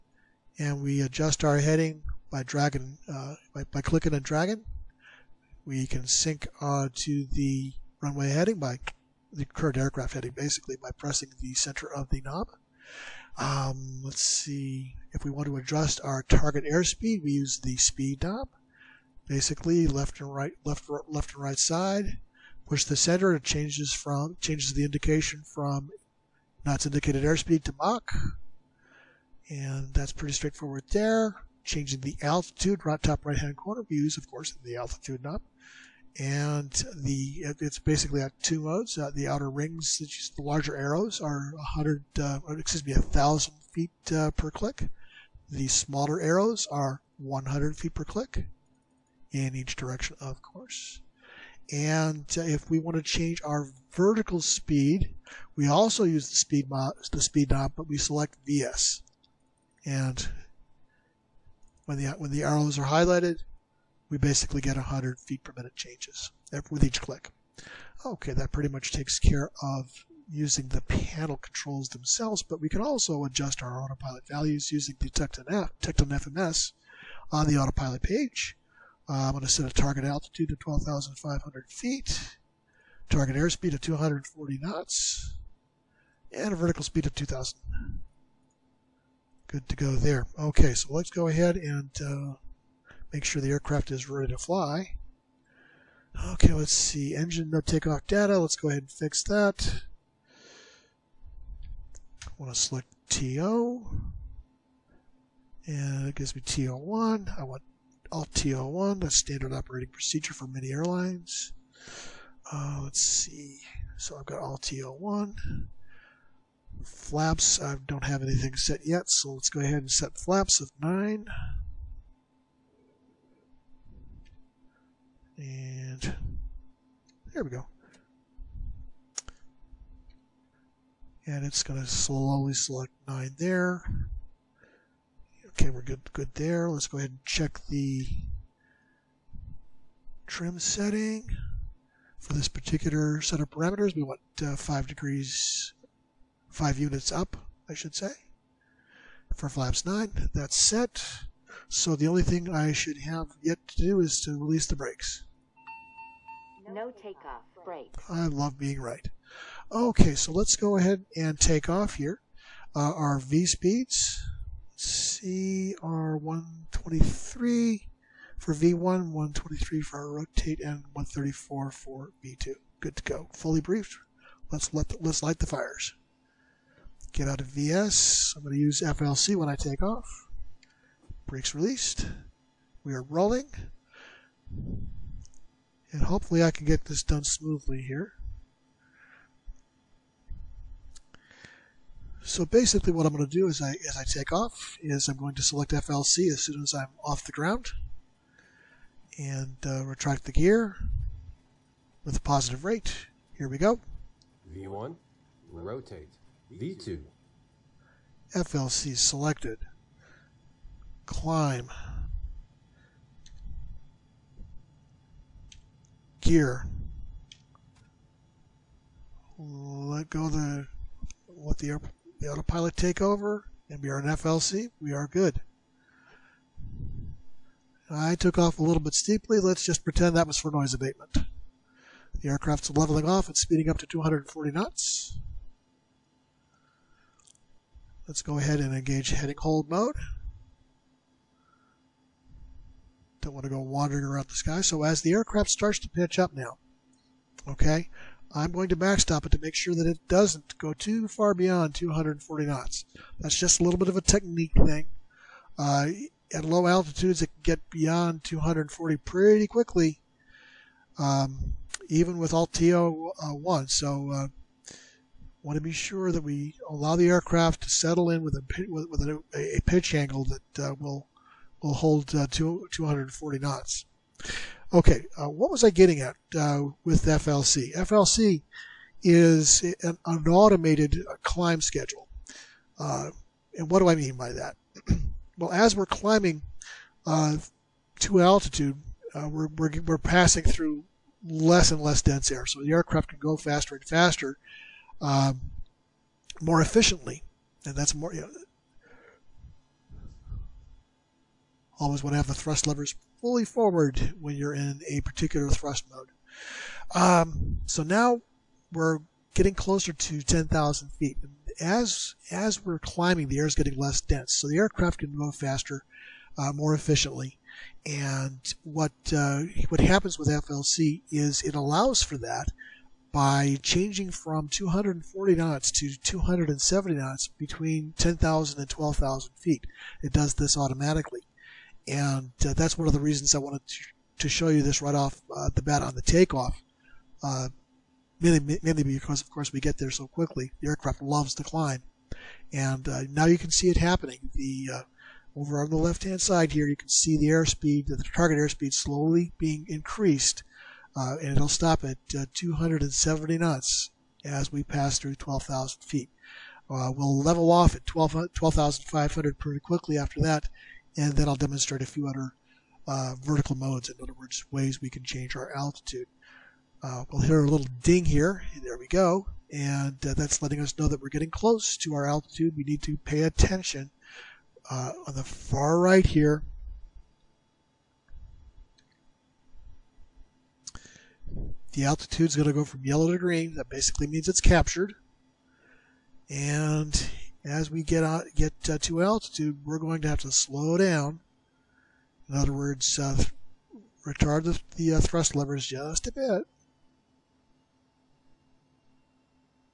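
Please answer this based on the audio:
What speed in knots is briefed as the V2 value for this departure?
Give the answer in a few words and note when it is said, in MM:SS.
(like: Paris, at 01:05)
134, at 02:50.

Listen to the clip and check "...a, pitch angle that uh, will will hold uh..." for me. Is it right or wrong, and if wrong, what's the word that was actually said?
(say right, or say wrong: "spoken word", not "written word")
right.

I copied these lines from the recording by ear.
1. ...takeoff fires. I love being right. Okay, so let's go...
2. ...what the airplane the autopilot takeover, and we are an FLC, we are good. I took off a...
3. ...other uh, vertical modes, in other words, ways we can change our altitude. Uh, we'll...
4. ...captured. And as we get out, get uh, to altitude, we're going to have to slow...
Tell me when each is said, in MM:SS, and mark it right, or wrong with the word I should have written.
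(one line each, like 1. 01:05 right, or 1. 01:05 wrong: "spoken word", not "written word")
1. 02:36 wrong: "brakes", not "fires"
2. 03:41 right
3. 06:02 right
4. 06:24 right.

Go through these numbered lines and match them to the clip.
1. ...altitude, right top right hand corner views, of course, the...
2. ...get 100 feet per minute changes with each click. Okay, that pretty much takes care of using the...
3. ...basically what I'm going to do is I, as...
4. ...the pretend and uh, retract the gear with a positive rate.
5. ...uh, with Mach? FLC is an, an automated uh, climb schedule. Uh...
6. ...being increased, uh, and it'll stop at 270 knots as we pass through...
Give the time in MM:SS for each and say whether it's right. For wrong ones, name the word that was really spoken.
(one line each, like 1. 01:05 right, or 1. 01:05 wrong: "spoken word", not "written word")
1. 00:32 right
2. 01:04 right
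3. 03:12 right
4. 03:17 wrong: "ground", not "pretend"
5. 04:36 wrong: "FLC", not "Mach"
6. 05:49 right.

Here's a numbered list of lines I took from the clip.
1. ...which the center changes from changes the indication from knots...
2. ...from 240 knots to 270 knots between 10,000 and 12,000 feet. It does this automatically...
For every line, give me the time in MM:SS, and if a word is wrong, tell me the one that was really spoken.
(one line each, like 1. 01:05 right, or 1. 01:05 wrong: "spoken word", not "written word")
1. 00:22 right
2. 05:24 right.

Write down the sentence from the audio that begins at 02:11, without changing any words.
And it's going to slowly select 9 there.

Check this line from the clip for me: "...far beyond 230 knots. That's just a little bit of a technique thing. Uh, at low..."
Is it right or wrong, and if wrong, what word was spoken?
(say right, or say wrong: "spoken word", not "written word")
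wrong: "240", not "230".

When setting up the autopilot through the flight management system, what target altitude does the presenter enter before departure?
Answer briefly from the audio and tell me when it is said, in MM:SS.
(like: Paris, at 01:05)
12,500 feet, at 01:20.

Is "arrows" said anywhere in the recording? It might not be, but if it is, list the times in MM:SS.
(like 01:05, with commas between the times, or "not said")
00:40, 00:46, 01:02.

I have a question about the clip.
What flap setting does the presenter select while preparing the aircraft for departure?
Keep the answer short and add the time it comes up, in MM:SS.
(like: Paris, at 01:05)
9, at 02:00.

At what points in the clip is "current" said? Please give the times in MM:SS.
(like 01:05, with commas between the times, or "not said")
00:09.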